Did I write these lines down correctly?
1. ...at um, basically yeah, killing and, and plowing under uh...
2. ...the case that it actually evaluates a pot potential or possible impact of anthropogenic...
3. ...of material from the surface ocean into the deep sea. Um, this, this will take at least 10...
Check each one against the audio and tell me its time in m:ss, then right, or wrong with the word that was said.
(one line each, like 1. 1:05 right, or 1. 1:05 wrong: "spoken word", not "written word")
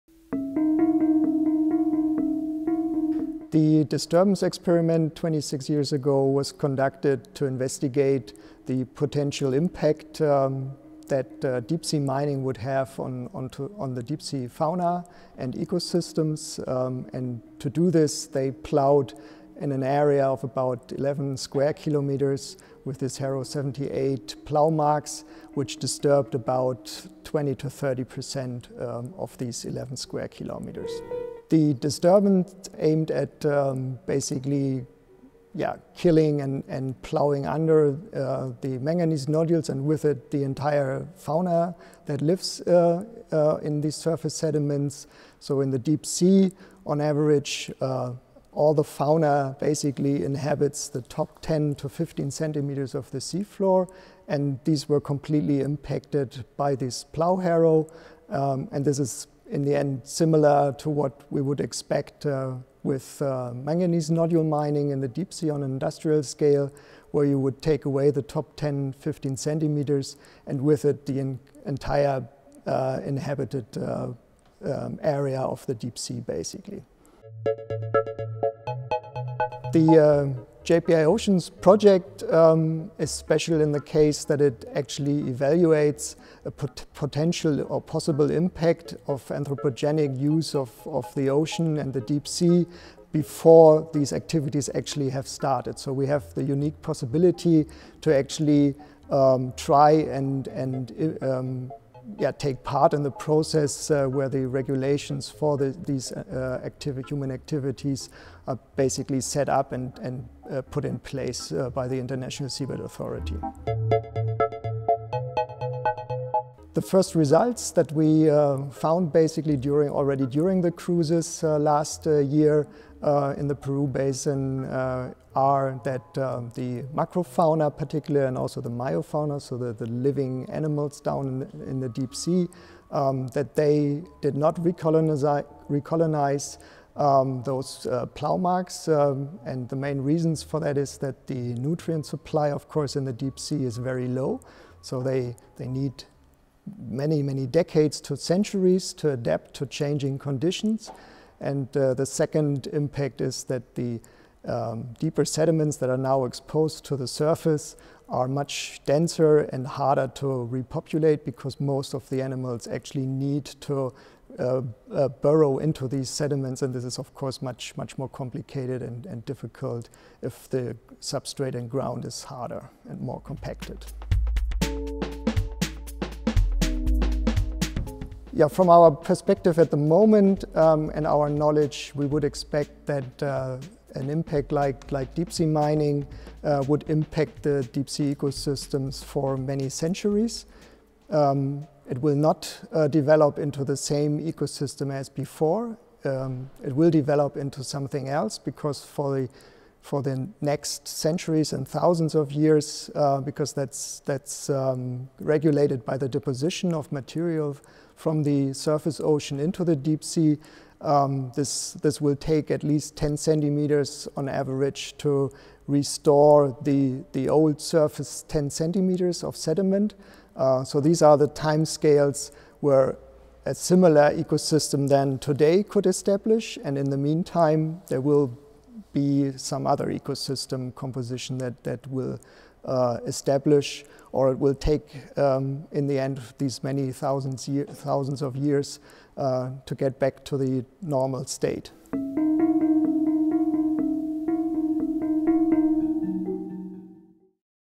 1. 0:33 right
2. 1:23 right
3. 3:26 right.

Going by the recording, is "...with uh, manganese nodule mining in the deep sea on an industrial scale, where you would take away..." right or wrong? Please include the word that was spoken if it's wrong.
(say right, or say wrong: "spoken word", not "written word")
right.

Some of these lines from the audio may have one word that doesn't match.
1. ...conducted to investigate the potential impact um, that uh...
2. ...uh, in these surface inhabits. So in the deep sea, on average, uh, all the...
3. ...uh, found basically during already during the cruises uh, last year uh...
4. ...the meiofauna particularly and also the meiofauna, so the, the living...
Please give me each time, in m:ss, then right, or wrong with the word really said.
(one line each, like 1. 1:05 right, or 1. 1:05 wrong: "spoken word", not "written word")
1. 0:06 right
2. 0:43 wrong: "sediments", not "inhabits"
3. 1:58 right
4. 2:06 wrong: "macrofauna", not "meiofauna".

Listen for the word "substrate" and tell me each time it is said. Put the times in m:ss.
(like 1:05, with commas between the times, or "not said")
2:51.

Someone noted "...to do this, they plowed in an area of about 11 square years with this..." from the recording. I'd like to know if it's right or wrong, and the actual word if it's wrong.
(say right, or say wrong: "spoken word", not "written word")
wrong: "kilometers", not "years".